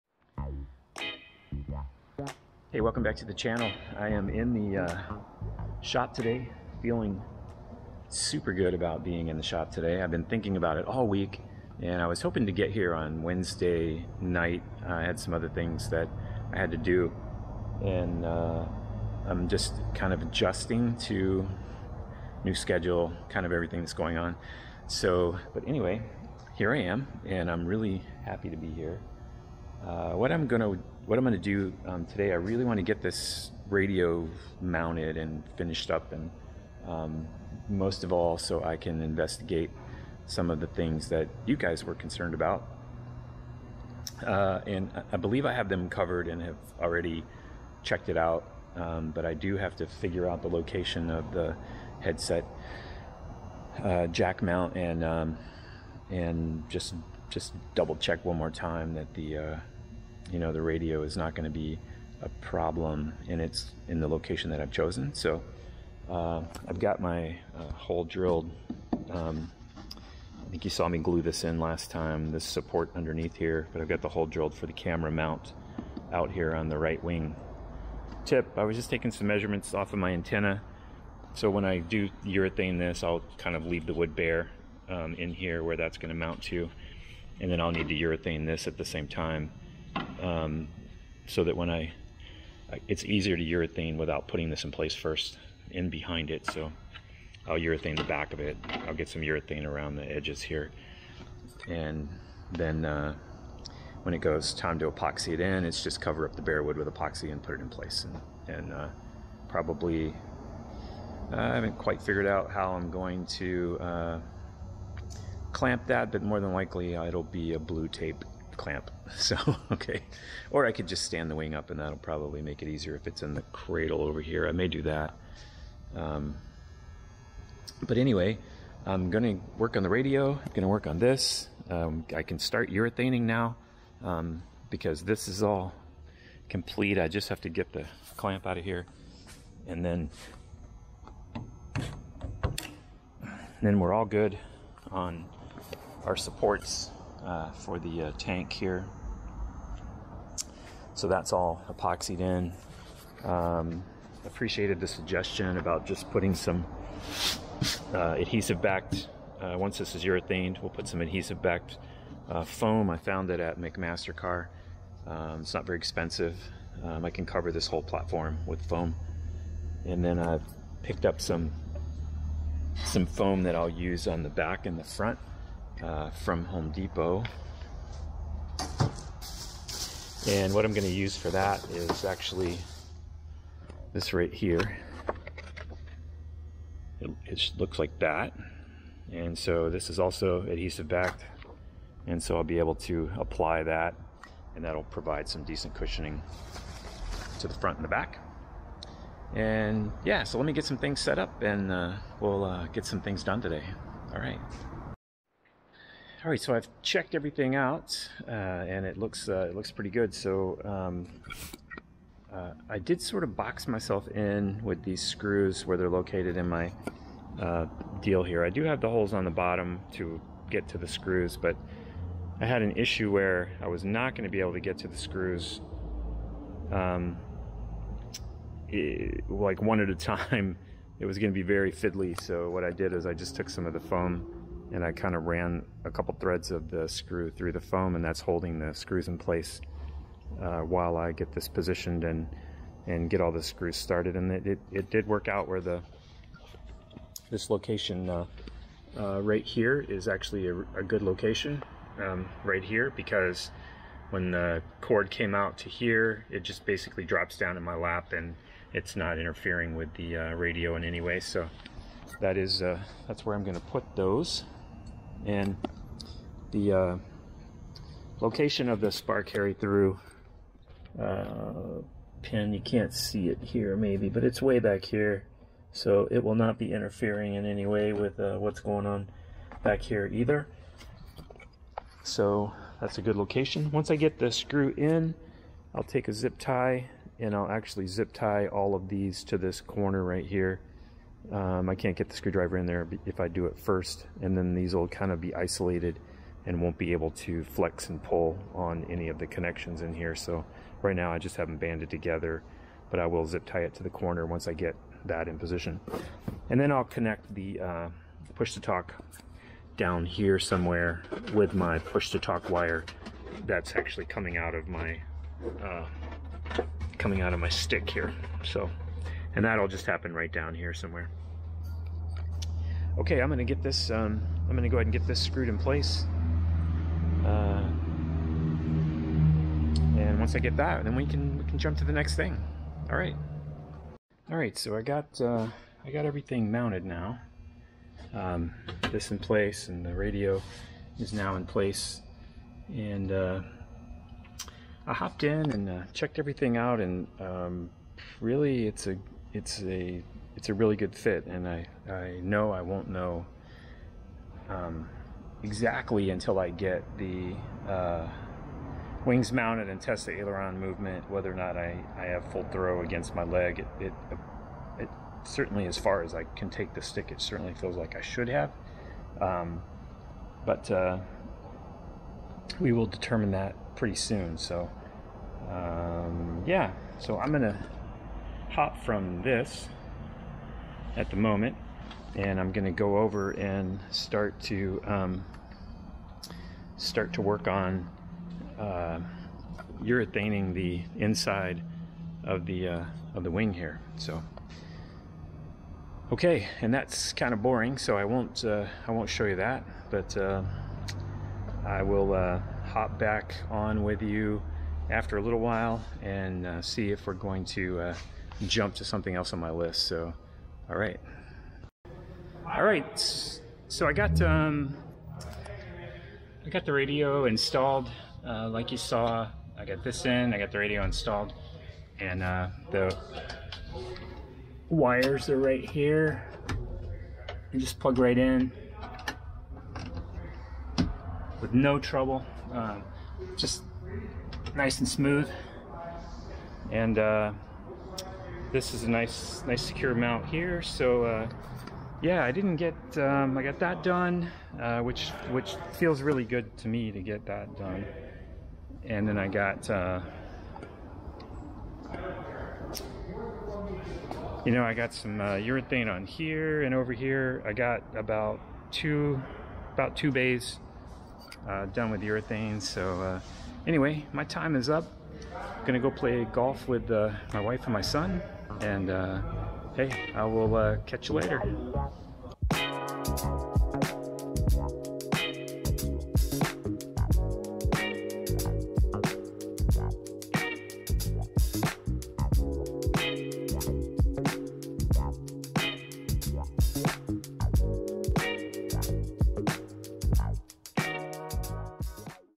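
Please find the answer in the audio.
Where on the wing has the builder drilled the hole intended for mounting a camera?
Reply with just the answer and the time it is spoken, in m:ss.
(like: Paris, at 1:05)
right wing tip, at 1:16.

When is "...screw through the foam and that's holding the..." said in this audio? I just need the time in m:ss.
3:56.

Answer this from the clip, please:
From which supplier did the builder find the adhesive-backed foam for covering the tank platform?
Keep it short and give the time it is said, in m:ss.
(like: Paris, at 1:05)
McMaster-Carr, at 2:43.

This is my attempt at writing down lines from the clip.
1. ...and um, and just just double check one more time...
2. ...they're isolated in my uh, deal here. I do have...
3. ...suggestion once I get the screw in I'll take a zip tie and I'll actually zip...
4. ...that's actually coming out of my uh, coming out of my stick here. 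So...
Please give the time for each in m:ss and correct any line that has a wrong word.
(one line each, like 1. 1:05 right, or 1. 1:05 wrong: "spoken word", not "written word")
1. 0:54 right
2. 3:35 wrong: "located", not "isolated"
3. 4:43 wrong: "location", not "suggestion"
4. 5:13 right.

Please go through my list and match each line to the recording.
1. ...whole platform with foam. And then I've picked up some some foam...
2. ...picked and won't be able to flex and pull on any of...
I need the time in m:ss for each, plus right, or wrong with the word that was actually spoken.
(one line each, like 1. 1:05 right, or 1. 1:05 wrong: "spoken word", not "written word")
1. 2:47 right
2. 4:55 wrong: "isolated", not "picked".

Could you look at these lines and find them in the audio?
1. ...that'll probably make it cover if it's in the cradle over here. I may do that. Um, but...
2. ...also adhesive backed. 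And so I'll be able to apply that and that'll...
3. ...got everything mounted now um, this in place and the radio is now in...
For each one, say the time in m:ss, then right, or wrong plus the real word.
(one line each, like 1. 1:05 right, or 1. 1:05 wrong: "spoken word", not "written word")
1. 2:01 wrong: "easier", not "cover"
2. 3:09 right
3. 5:35 right.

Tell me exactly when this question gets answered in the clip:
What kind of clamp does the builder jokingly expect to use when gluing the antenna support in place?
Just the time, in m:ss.
1:57.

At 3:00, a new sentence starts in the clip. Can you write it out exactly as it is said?
And what I'm going to use for that is actually this right here.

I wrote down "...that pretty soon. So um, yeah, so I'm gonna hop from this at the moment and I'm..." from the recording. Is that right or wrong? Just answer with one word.
right.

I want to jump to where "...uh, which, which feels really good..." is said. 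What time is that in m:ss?
7:24.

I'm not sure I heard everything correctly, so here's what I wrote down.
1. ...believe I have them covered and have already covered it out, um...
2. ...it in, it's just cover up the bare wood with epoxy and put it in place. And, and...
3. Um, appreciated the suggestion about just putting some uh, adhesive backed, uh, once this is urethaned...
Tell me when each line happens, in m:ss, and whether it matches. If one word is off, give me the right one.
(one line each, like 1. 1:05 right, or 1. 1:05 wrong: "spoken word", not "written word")
1. 0:45 wrong: "checked", not "covered"
2. 1:45 right
3. 2:33 right.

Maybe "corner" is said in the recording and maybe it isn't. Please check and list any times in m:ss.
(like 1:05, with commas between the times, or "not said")
4:49, 5:03.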